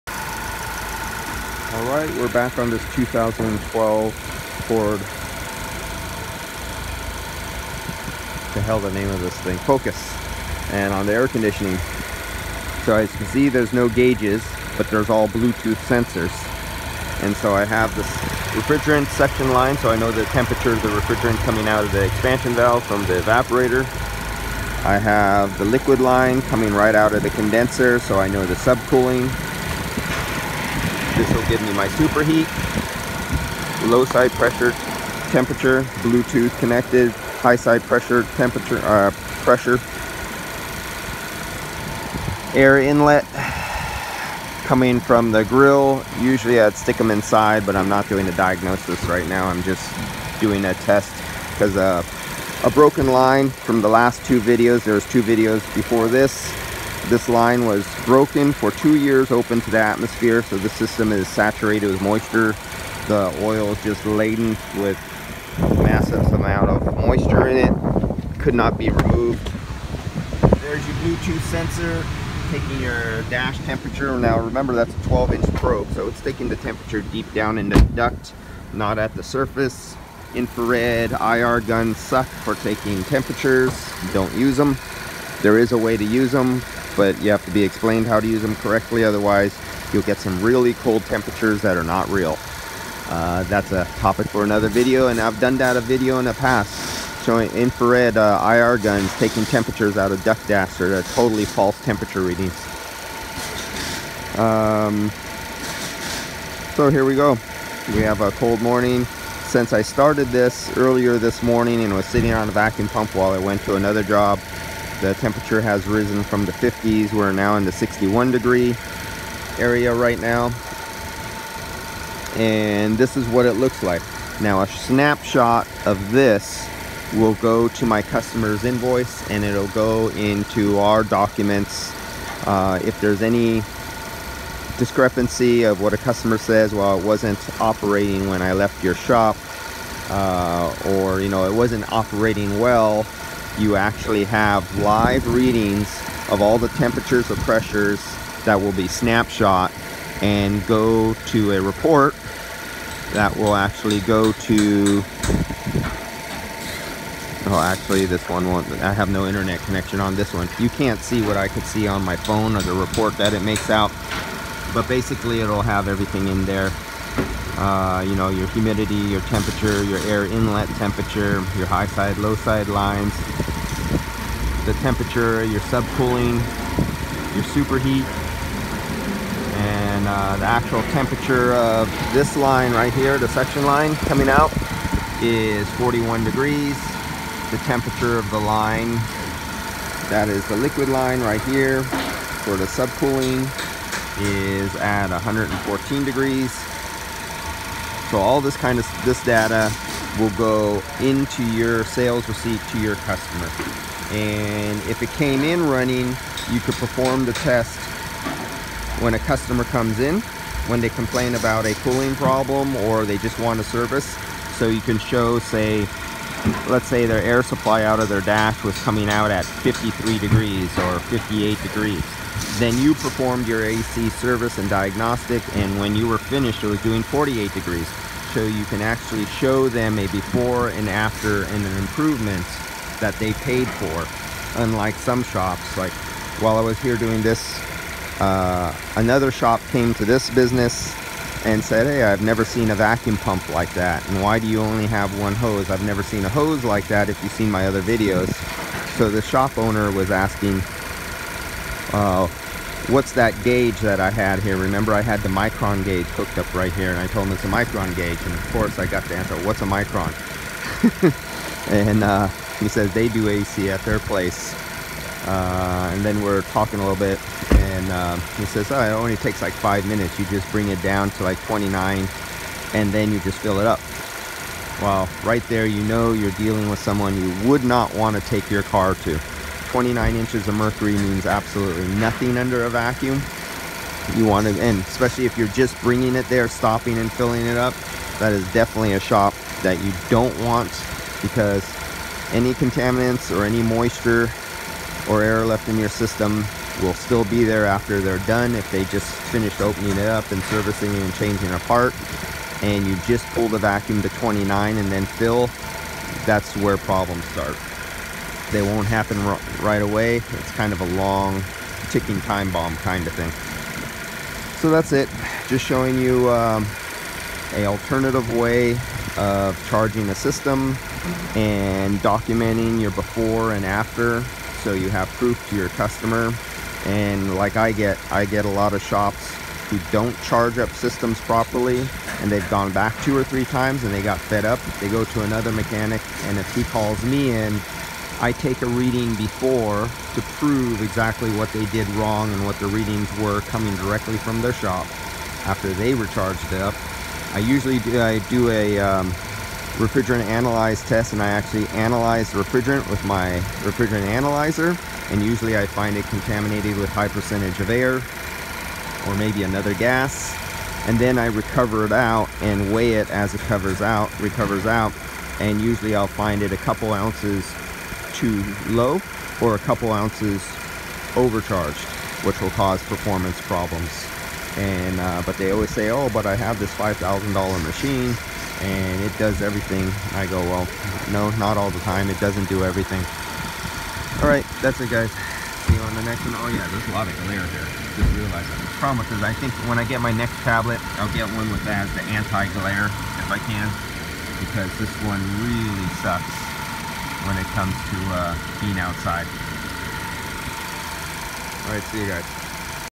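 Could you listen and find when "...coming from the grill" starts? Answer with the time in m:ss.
0:44.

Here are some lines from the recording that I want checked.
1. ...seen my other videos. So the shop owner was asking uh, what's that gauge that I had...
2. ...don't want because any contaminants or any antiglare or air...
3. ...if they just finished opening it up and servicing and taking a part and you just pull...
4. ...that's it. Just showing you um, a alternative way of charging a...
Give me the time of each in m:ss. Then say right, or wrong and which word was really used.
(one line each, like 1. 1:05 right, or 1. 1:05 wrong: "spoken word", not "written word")
1. 4:07 right
2. 4:50 wrong: "moisture", not "antiglare"
3. 4:58 wrong: "changing", not "taking"
4. 5:14 right.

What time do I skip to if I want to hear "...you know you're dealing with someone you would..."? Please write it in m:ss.
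4:35.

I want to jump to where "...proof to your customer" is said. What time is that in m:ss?
5:25.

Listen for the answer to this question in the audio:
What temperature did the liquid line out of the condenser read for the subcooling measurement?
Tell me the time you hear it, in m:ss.
3:15.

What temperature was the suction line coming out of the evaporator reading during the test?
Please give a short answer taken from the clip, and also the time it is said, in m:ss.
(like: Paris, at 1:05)
41 degrees, at 3:05.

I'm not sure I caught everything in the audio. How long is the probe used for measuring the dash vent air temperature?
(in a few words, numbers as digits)
12 inch.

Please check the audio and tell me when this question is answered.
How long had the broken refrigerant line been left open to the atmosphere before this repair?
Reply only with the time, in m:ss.
0:58.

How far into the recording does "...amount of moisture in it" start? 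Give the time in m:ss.
1:06.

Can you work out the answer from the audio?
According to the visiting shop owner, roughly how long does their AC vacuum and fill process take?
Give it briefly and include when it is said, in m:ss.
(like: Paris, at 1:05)
5 minutes, at 4:29.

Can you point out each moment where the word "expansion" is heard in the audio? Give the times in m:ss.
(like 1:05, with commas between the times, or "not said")
0:22.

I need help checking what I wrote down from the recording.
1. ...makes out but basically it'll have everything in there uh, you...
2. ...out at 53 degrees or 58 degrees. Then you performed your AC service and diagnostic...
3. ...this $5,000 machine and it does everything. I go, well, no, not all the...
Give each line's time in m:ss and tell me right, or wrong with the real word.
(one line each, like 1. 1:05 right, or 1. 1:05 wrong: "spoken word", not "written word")
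1. 2:43 right
2. 3:39 right
3. 6:16 right.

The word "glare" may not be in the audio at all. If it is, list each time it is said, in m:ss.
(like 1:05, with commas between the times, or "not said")
6:27, 6:32.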